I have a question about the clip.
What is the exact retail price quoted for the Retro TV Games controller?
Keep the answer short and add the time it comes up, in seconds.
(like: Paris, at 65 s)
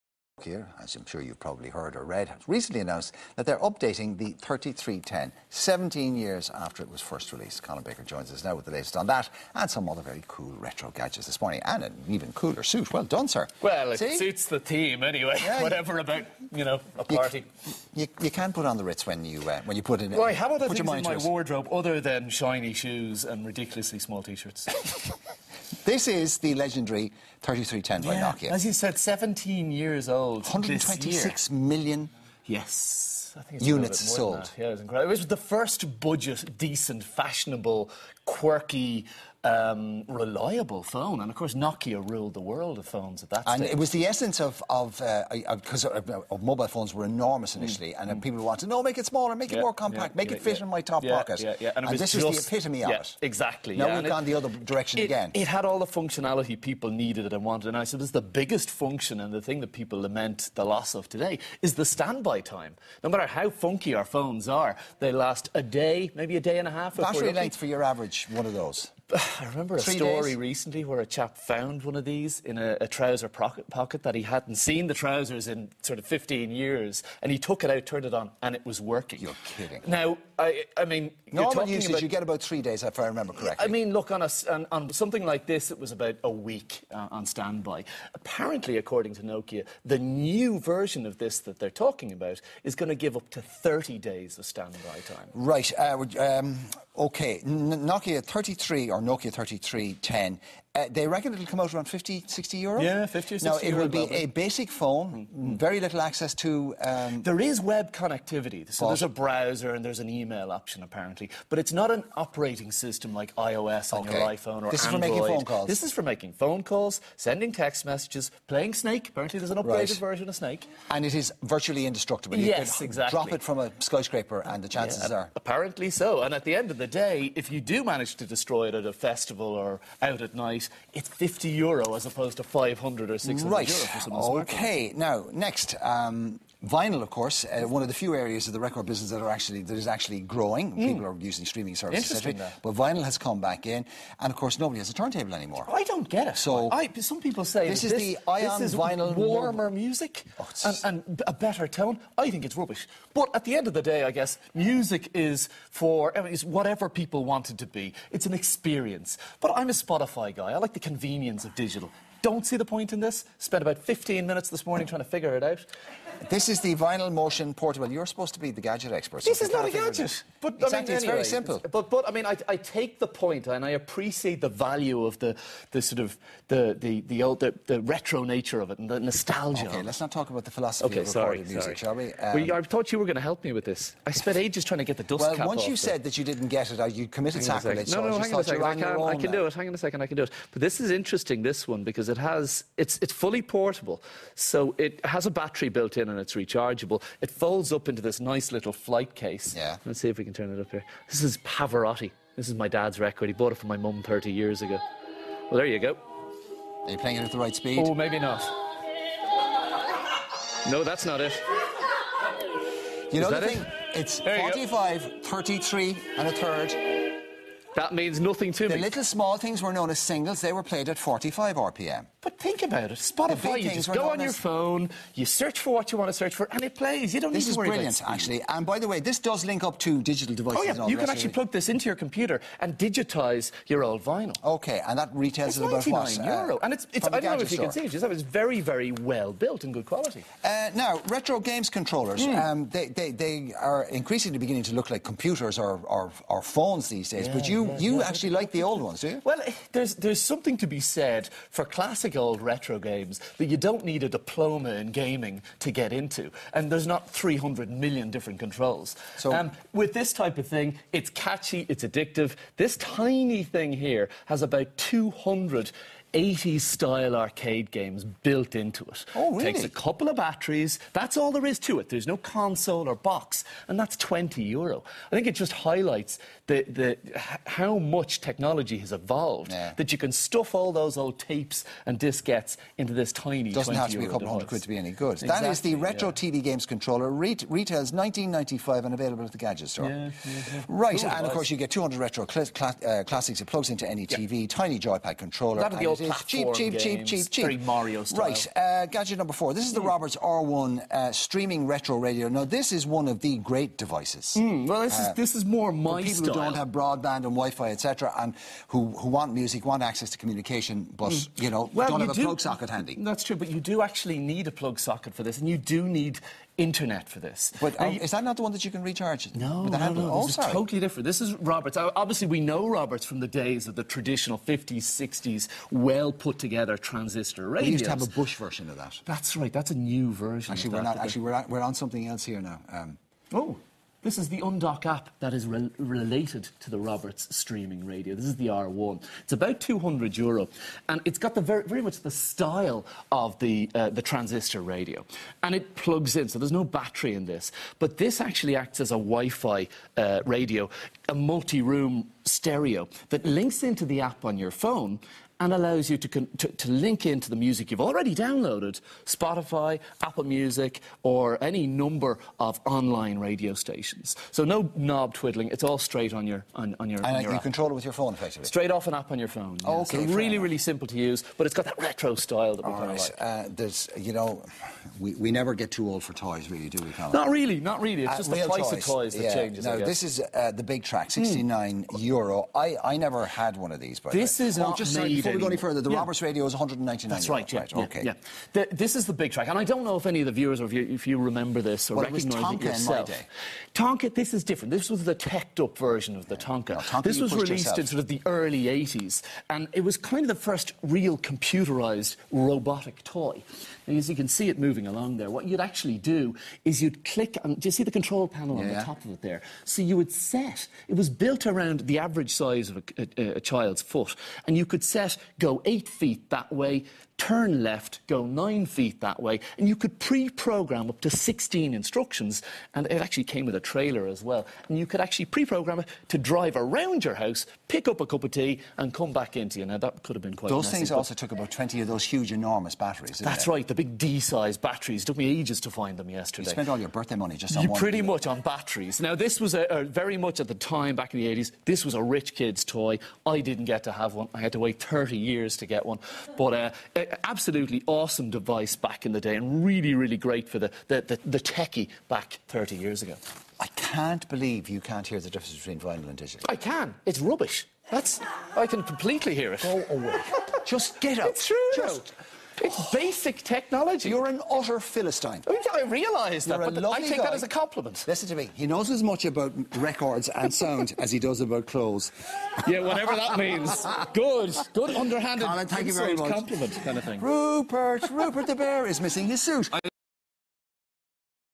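19.95, at 287 s.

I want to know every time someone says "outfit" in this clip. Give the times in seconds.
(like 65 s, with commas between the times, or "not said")
not said.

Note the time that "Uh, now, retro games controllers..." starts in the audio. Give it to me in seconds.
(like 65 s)
240 s.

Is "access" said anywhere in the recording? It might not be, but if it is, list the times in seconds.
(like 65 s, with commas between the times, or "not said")
105 s, 309 s.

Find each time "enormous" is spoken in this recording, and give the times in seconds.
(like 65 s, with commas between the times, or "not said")
47 s, 432 s.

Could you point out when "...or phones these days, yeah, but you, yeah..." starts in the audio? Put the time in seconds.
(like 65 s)
246 s.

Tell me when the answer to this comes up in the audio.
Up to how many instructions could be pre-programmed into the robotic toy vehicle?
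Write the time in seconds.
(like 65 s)
421 s.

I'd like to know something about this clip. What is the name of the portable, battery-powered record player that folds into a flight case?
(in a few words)
Vinyl Motion.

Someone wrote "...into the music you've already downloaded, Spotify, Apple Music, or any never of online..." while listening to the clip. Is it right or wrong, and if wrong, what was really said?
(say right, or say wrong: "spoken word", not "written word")
wrong: "number", not "never".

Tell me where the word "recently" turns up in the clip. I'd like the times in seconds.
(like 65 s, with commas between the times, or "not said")
2 s, 70 s.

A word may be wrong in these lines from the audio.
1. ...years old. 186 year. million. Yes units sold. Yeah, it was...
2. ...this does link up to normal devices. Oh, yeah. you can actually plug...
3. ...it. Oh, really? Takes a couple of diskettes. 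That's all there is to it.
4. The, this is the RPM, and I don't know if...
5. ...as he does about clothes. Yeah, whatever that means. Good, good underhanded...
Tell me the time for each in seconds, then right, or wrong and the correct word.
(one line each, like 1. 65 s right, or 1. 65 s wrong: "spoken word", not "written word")
1. 29 s wrong: "126", not "186"
2. 228 s wrong: "digital", not "normal"
3. 268 s wrong: "batteries", not "diskettes"
4. 388 s wrong: "Bigtrak", not "RPM"
5. 470 s right.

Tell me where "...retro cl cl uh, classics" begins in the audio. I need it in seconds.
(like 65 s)
291 s.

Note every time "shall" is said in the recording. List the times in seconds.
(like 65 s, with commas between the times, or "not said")
181 s.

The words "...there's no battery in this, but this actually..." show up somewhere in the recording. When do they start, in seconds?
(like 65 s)
346 s.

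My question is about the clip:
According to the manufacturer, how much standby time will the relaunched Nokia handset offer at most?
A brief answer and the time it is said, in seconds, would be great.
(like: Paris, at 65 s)
30 days, at 93 s.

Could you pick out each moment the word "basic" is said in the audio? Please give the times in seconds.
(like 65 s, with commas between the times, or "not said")
104 s, 462 s.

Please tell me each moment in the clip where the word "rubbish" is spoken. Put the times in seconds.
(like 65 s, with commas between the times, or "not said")
152 s, 457 s.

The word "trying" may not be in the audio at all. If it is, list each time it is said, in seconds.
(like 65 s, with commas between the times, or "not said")
164 s, 184 s.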